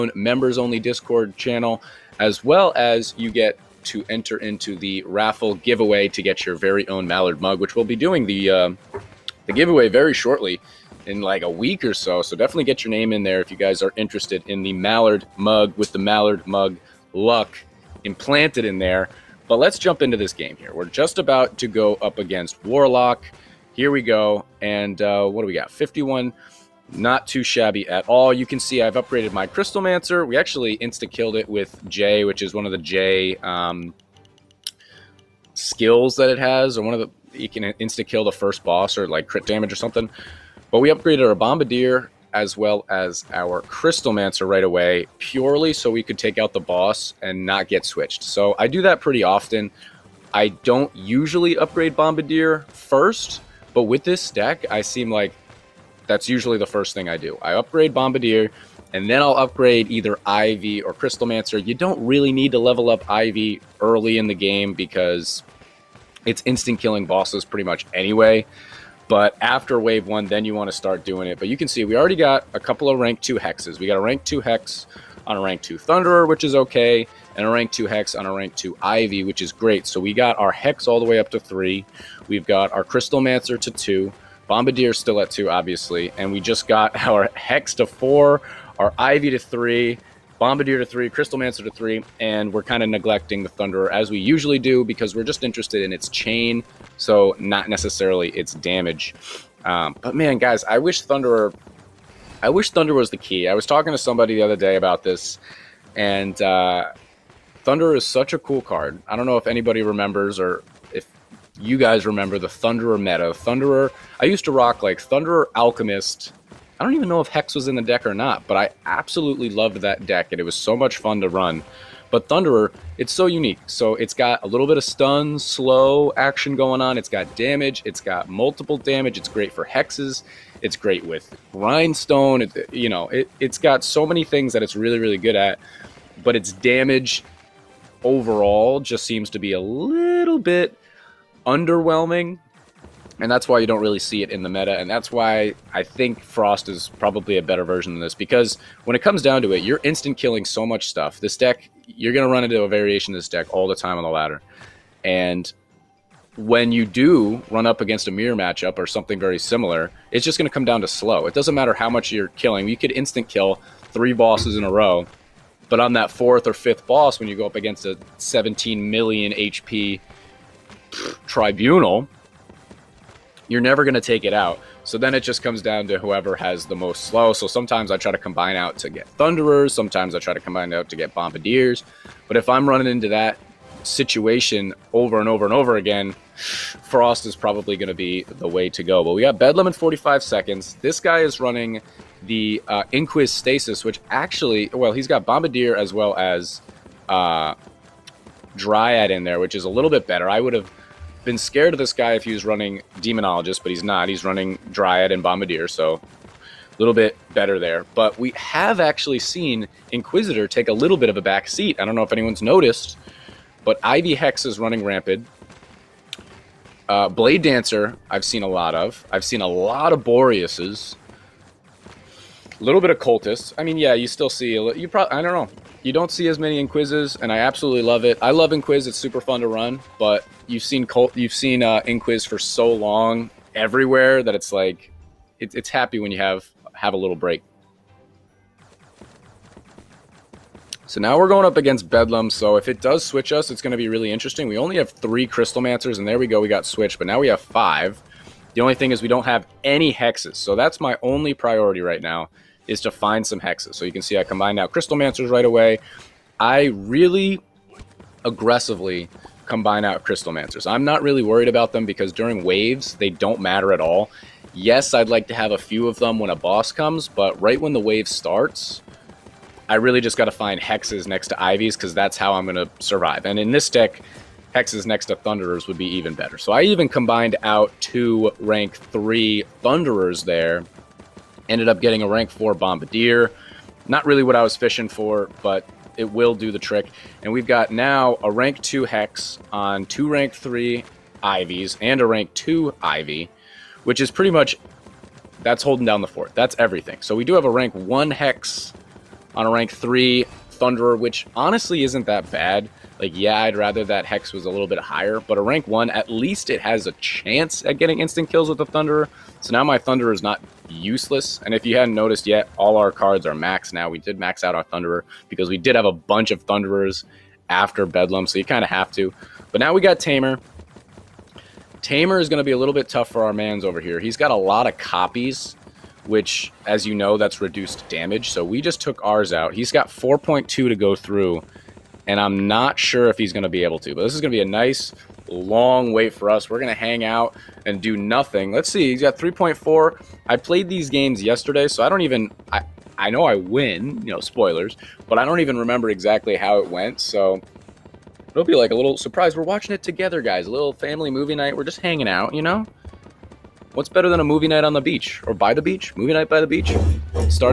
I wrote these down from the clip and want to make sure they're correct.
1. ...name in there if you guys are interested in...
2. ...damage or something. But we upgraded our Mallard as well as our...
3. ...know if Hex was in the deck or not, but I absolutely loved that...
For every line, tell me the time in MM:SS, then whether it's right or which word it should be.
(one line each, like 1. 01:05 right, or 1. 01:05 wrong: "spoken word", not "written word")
1. 00:12 right
2. 00:39 wrong: "Bombardier", not "Mallard"
3. 01:57 right.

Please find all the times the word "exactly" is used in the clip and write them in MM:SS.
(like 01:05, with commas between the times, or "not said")
05:45.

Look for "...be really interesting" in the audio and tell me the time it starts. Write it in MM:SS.
04:03.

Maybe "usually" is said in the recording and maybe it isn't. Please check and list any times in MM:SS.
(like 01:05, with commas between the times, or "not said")
00:50, 00:56, 01:34.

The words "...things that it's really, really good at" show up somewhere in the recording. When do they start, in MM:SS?
02:14.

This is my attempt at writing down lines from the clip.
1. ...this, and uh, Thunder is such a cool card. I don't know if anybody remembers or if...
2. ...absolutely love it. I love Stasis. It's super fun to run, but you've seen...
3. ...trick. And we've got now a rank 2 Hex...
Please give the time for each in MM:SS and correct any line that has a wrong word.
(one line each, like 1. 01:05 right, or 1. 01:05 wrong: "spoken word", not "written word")
1. 01:45 right
2. 03:47 wrong: "Inquiz", not "Stasis"
3. 04:46 right.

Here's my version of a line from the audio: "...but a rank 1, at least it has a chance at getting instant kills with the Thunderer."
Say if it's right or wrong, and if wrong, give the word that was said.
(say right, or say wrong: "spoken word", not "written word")
right.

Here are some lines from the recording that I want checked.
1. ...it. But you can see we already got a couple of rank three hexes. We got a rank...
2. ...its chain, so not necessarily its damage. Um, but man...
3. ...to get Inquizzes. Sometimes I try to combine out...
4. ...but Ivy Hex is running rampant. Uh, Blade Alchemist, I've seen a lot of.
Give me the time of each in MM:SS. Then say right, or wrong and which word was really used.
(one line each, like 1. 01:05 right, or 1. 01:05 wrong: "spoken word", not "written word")
1. 01:11 wrong: "two", not "three"
2. 01:35 right
3. 02:58 wrong: "Thunderers", not "Inquizzes"
4. 03:33 wrong: "Dancer", not "Alchemist".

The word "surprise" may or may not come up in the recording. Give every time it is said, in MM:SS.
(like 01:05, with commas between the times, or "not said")
05:48.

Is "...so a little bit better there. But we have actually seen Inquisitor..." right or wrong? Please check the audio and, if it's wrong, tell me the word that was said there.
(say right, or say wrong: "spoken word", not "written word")
right.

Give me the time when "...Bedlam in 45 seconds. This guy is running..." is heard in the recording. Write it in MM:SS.
03:09.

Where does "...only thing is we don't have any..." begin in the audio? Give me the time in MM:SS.
04:08.